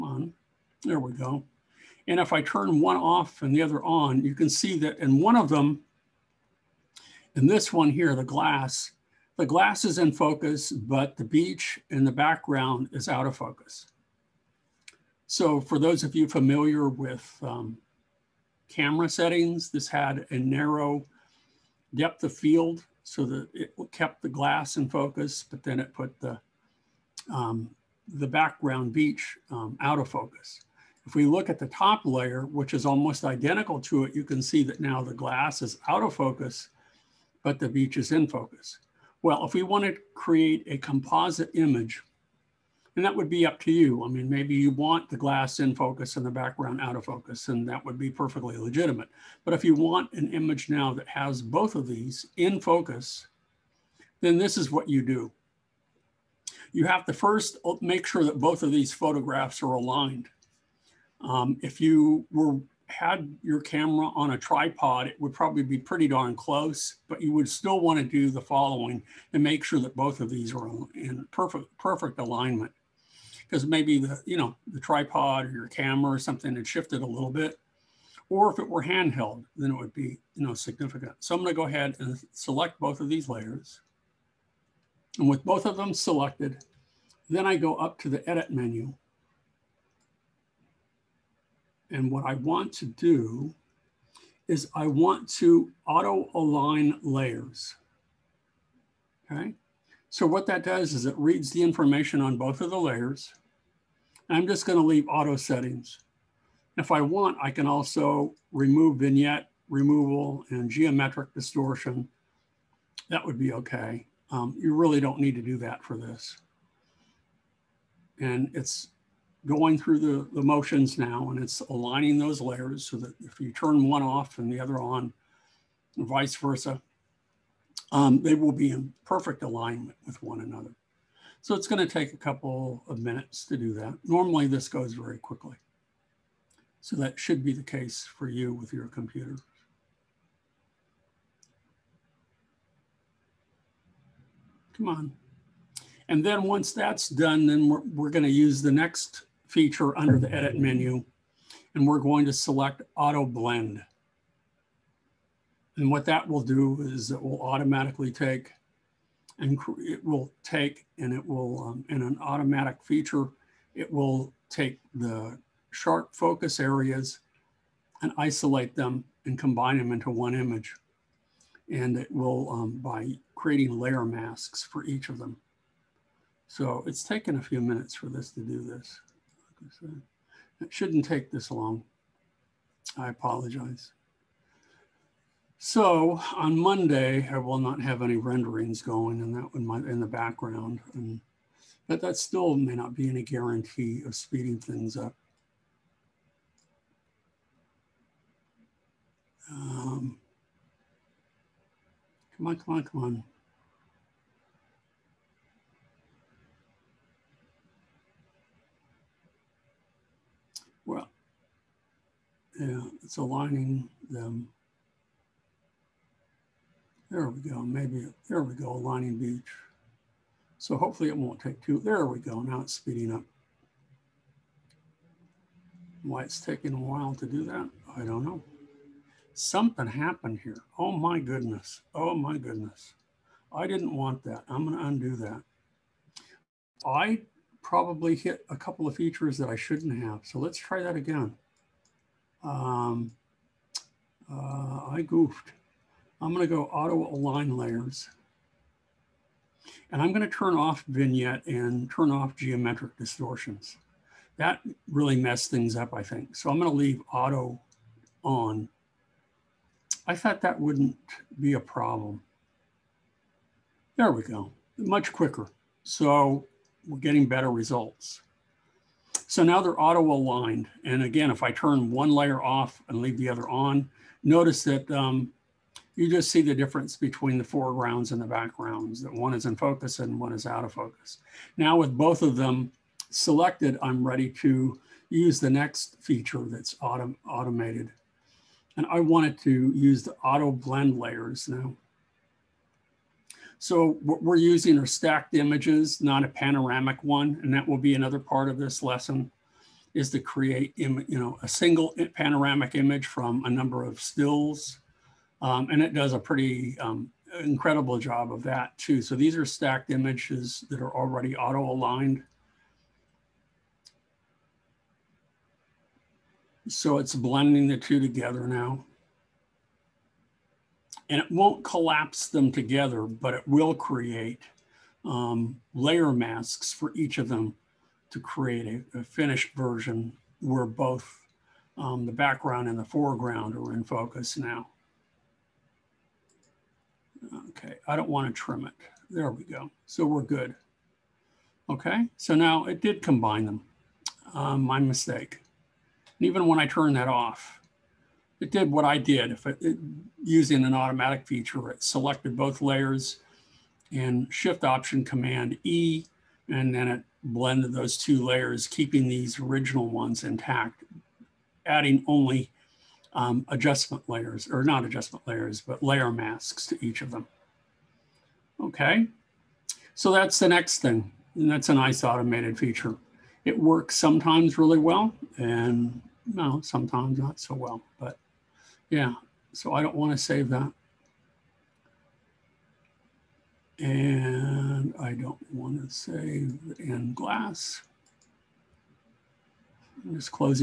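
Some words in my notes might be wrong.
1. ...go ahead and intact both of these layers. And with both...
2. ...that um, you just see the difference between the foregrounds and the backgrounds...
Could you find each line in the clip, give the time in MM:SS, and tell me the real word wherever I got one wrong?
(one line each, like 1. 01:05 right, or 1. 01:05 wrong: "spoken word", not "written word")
1. 01:21 wrong: "select", not "intact"
2. 04:34 right.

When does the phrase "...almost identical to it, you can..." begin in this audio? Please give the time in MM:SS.
00:32.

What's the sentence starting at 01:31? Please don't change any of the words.
And what I want to do is I want to auto align layers.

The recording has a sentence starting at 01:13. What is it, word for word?
Because maybe the, you know, the tripod or your camera or something had shifted a little bit.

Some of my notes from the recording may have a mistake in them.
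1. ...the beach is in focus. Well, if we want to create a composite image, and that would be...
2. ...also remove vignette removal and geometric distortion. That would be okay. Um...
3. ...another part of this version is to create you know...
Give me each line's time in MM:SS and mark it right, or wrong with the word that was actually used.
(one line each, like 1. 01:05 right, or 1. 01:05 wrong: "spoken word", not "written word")
1. 00:37 right
2. 01:47 right
3. 04:57 wrong: "lesson", not "version".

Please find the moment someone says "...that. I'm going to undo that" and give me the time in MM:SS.
03:54.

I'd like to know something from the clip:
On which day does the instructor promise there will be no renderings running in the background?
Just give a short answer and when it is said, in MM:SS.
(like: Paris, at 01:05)
Monday, at 03:06.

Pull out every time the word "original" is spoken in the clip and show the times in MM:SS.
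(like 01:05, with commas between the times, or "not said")
05:59.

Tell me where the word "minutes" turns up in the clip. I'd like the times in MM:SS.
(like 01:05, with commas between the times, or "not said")
02:12, 02:57.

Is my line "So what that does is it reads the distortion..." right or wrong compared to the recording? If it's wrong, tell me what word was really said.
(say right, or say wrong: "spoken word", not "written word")
wrong: "information", not "distortion".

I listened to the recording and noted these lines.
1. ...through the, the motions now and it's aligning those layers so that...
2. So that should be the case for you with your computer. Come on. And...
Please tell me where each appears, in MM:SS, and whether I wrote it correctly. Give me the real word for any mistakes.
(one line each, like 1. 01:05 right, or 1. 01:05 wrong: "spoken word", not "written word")
1. 01:59 right
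2. 02:16 right.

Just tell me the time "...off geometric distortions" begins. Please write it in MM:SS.
04:12.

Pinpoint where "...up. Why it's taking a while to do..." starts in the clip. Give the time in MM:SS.
03:43.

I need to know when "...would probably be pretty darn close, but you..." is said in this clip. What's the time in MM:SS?
01:05.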